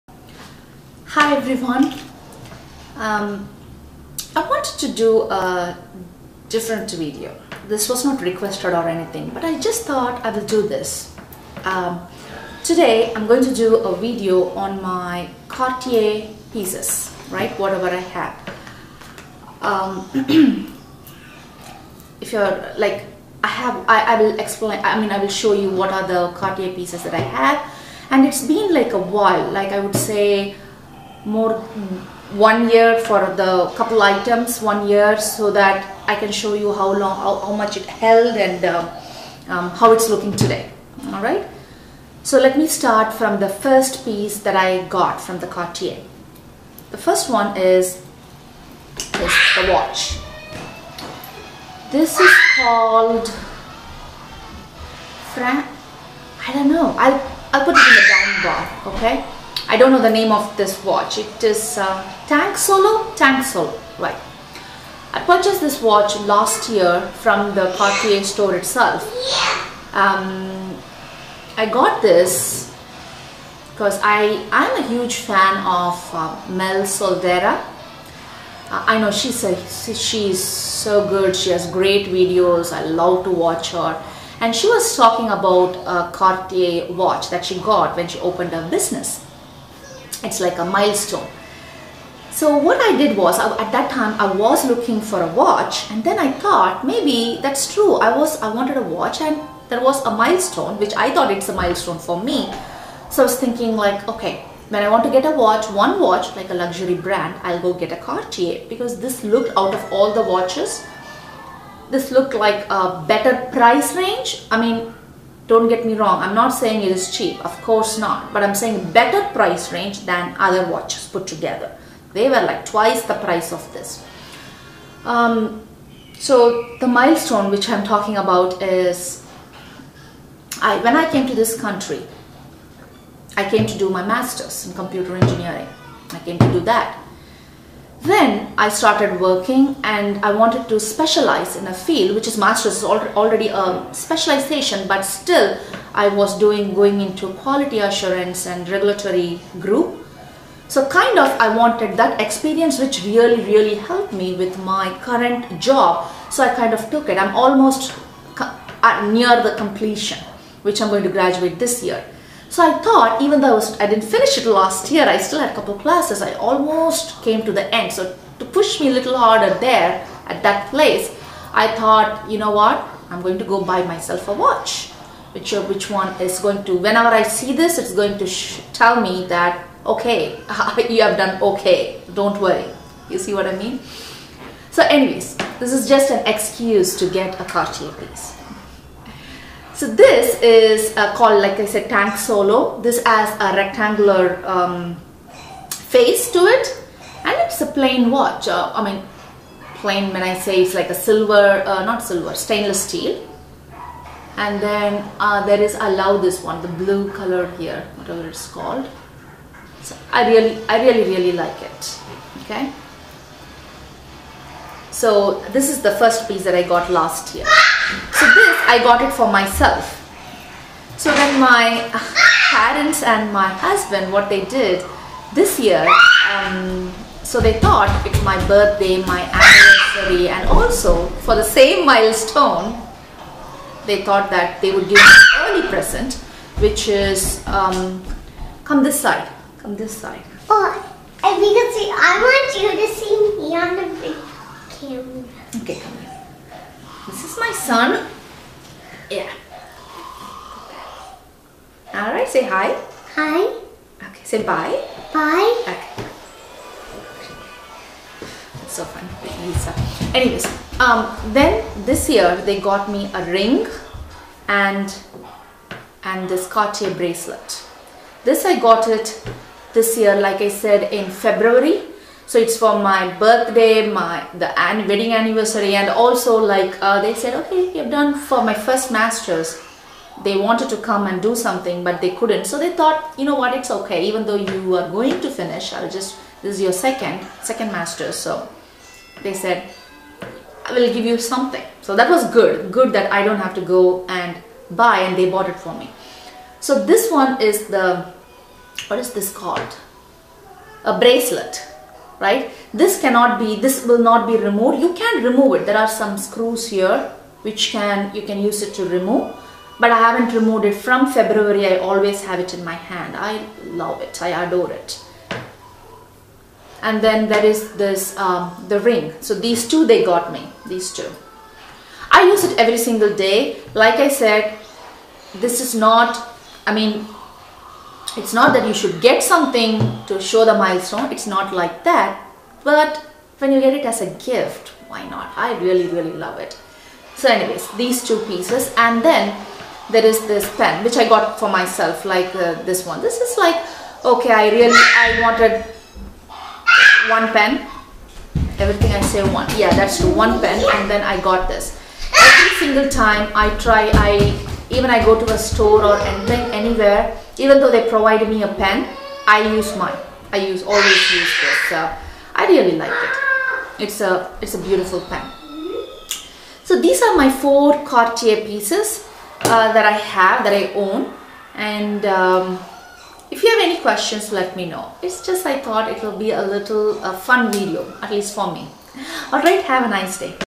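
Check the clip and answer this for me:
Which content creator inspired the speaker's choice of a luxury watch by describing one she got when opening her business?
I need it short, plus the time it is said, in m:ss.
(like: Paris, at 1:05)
Mel Soldera, at 1:16.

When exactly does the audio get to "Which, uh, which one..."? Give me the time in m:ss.
2:55.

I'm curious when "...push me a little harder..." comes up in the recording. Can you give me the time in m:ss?
2:48.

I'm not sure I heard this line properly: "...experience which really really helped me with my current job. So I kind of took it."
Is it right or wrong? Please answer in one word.
right.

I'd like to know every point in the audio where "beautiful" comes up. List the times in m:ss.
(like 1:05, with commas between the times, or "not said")
6:04.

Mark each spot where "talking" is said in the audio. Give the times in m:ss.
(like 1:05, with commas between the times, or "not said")
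1:24, 2:07.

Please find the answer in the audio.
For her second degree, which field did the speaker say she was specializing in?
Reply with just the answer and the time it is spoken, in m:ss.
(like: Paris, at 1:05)
Quality assurance and regulatory, at 2:27.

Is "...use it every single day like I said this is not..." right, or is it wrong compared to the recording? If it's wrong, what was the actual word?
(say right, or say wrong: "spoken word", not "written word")
right.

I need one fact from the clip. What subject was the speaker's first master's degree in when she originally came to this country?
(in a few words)
Computer engineering.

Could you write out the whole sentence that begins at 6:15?
It's just I thought it will be a little a fun video, at least for me.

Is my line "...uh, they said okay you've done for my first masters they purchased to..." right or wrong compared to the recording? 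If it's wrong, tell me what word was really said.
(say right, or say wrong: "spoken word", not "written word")
wrong: "wanted", not "purchased".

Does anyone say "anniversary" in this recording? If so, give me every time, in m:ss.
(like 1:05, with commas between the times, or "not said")
3:49, 4:35.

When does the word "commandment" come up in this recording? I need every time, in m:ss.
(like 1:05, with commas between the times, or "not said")
not said.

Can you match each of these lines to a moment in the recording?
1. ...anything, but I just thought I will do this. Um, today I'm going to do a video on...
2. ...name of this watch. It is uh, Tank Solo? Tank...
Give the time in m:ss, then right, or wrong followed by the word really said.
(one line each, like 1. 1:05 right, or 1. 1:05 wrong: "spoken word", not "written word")
1. 0:08 right
2. 1:00 right.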